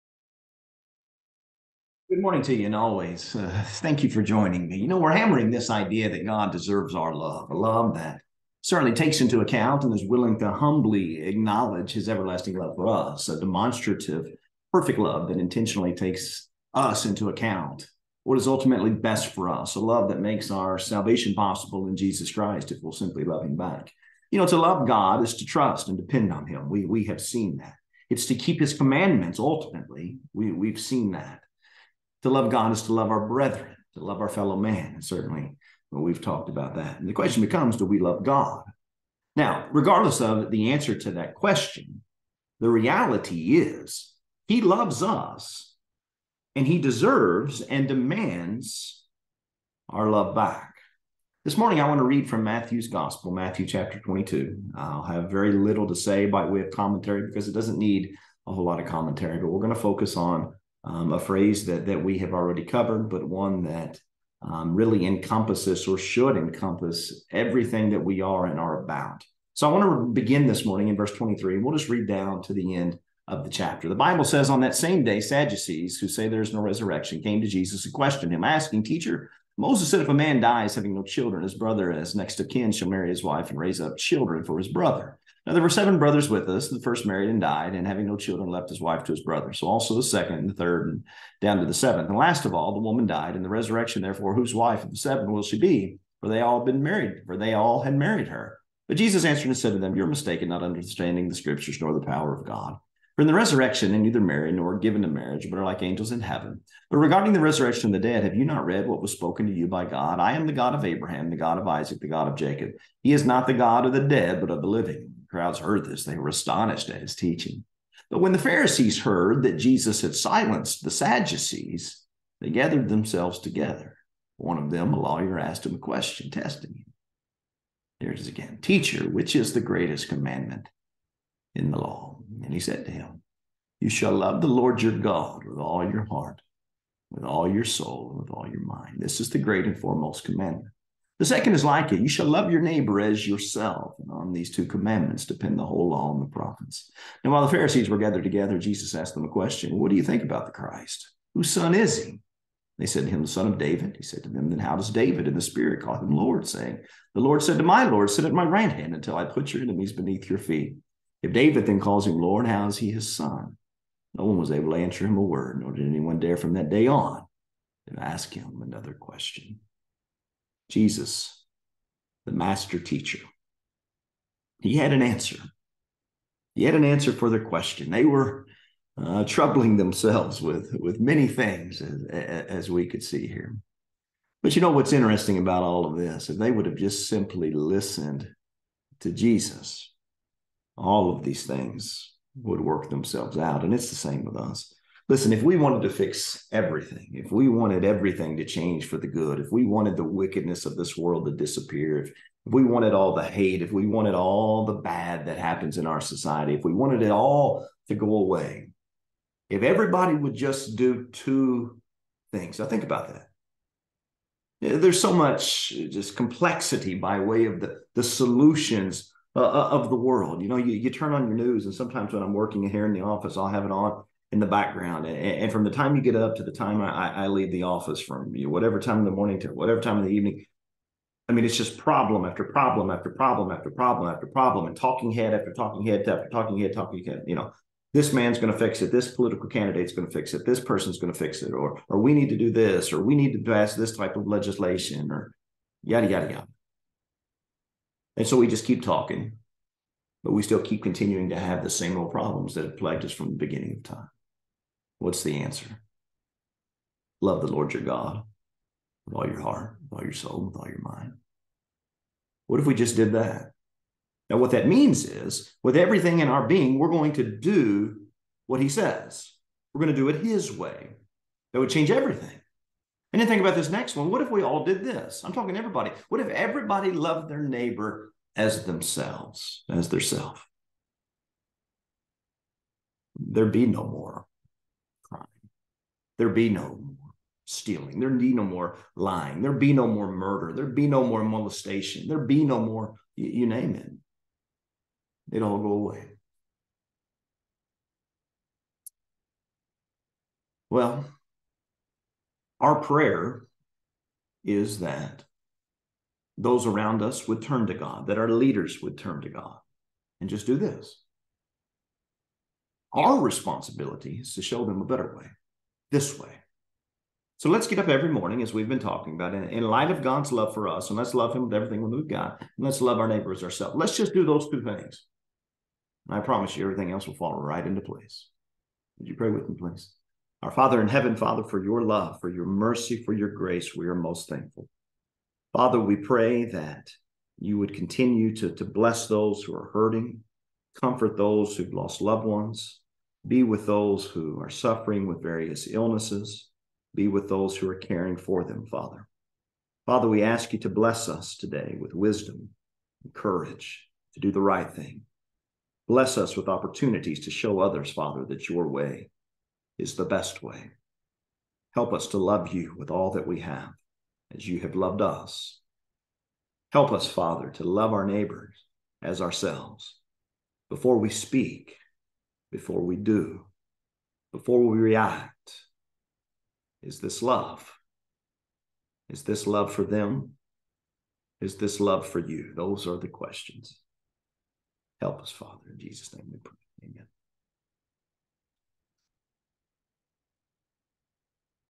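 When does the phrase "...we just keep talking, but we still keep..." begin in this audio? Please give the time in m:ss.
4:08.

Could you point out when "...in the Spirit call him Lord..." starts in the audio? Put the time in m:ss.
2:35.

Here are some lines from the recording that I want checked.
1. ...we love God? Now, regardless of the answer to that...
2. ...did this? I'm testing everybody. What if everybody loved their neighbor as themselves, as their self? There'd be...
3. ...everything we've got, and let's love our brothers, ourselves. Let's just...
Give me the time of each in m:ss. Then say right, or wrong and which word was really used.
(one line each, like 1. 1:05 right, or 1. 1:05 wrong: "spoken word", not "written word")
1. 0:37 right
2. 4:34 wrong: "talking", not "testing"
3. 5:21 wrong: "neighbors", not "brothers".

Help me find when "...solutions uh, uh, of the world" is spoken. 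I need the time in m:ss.
3:38.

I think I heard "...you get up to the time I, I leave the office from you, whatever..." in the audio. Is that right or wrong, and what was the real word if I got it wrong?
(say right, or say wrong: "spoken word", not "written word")
right.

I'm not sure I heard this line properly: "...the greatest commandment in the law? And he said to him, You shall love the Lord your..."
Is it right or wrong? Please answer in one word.
right.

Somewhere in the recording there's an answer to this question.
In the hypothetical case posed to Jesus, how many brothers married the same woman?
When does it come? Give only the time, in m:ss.
1:25.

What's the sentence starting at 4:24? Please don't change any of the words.
Now, what that means is, with everything in our being, we're going to do what he says.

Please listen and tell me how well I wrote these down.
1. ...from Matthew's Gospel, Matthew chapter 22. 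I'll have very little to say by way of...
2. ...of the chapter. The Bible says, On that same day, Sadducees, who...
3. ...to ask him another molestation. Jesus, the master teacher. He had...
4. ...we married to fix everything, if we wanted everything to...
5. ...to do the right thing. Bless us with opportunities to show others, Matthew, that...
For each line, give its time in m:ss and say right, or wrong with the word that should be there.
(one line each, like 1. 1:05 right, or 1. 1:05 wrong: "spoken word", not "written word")
1. 0:52 right
2. 1:13 right
3. 2:47 wrong: "question", not "molestation"
4. 3:15 wrong: "wanted", not "married"
5. 5:54 wrong: "Father", not "Matthew".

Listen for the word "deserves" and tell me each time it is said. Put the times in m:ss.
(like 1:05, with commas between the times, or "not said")
0:06, 0:46.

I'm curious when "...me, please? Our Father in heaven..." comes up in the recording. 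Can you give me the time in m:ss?
5:29.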